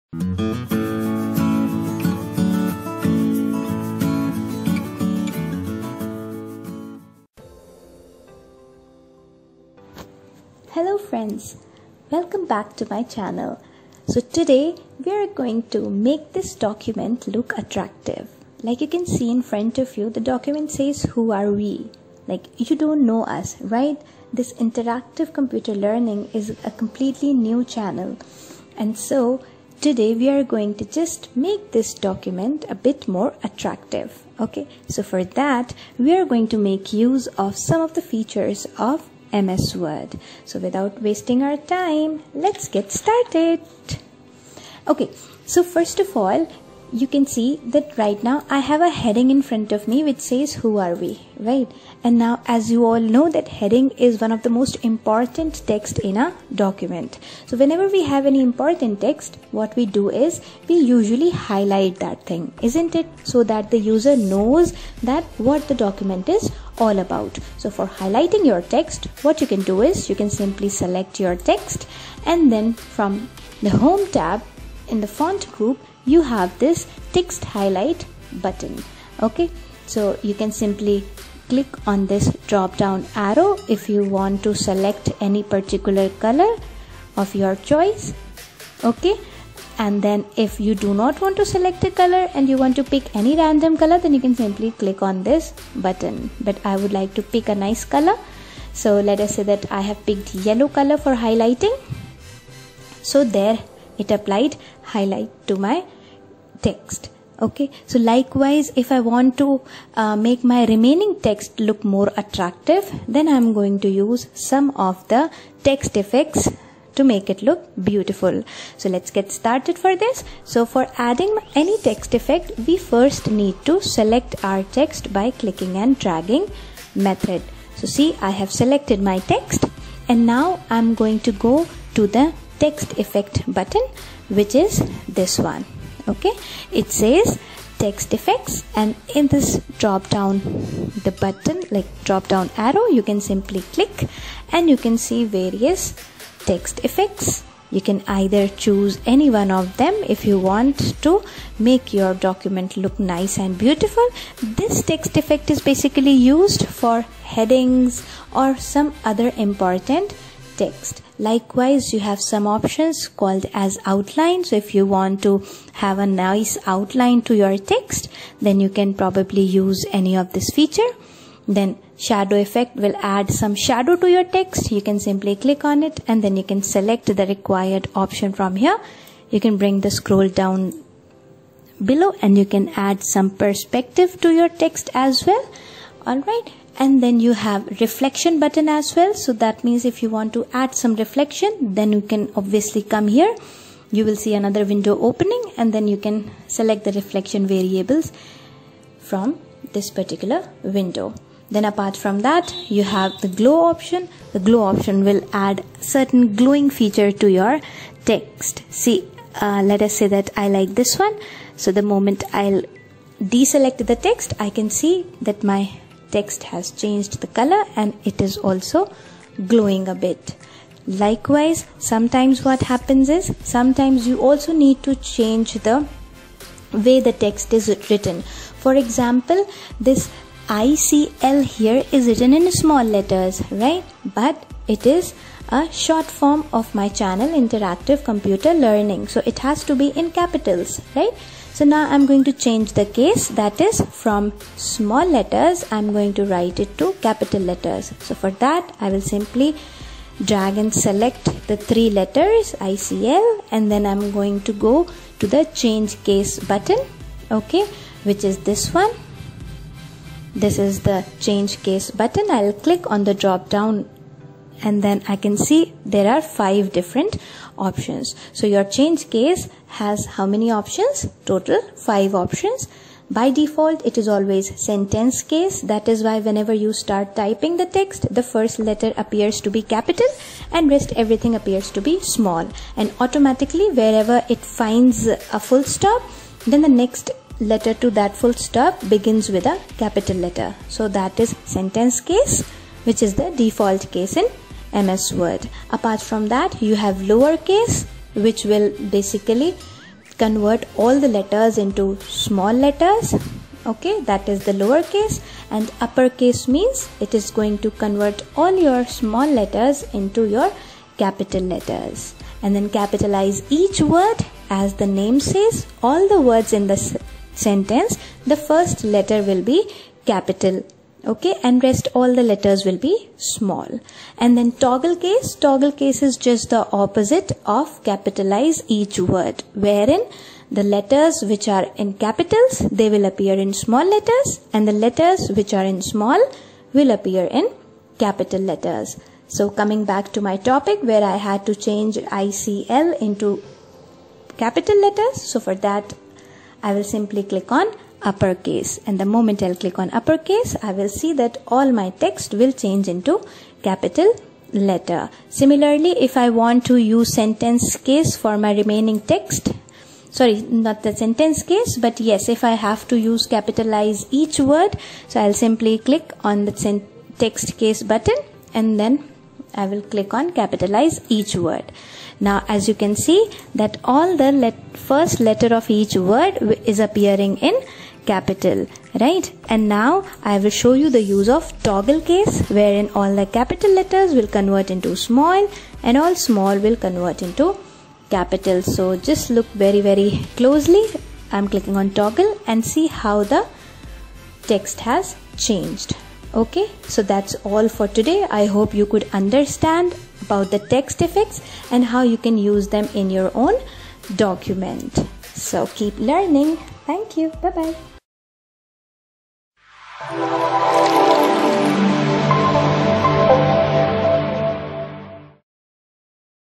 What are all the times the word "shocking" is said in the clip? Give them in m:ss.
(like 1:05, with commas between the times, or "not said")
not said.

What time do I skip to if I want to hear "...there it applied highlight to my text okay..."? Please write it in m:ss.
1:43.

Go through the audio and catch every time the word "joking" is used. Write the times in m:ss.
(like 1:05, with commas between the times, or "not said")
not said.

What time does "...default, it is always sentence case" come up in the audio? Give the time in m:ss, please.
4:33.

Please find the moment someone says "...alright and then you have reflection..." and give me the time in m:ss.
3:06.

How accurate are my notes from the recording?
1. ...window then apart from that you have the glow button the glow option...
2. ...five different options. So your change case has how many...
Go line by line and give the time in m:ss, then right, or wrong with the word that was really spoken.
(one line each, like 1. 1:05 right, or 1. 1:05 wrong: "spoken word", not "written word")
1. 3:20 wrong: "option", not "button"
2. 4:26 right.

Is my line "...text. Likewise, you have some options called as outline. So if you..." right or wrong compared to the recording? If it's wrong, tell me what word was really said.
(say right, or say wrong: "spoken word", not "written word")
right.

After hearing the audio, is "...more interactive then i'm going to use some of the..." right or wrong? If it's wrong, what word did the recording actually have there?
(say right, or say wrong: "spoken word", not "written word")
wrong: "attractive", not "interactive".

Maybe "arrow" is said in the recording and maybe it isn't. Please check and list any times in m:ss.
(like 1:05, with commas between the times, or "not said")
1:23, 2:22.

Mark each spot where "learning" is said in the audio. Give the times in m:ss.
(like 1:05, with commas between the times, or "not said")
0:25, 3:58, 6:45.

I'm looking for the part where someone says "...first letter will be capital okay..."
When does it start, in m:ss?
5:18.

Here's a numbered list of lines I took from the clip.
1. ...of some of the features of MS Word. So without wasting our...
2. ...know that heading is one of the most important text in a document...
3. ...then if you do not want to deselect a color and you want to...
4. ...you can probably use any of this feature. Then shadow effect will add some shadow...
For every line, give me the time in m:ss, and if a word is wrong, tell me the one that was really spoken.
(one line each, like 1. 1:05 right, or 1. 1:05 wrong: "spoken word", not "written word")
1. 0:37 right
2. 0:52 right
3. 1:30 wrong: "select", not "deselect"
4. 2:48 right.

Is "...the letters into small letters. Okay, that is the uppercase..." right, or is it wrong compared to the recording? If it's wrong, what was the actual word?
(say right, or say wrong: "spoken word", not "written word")
wrong: "lowercase", not "uppercase".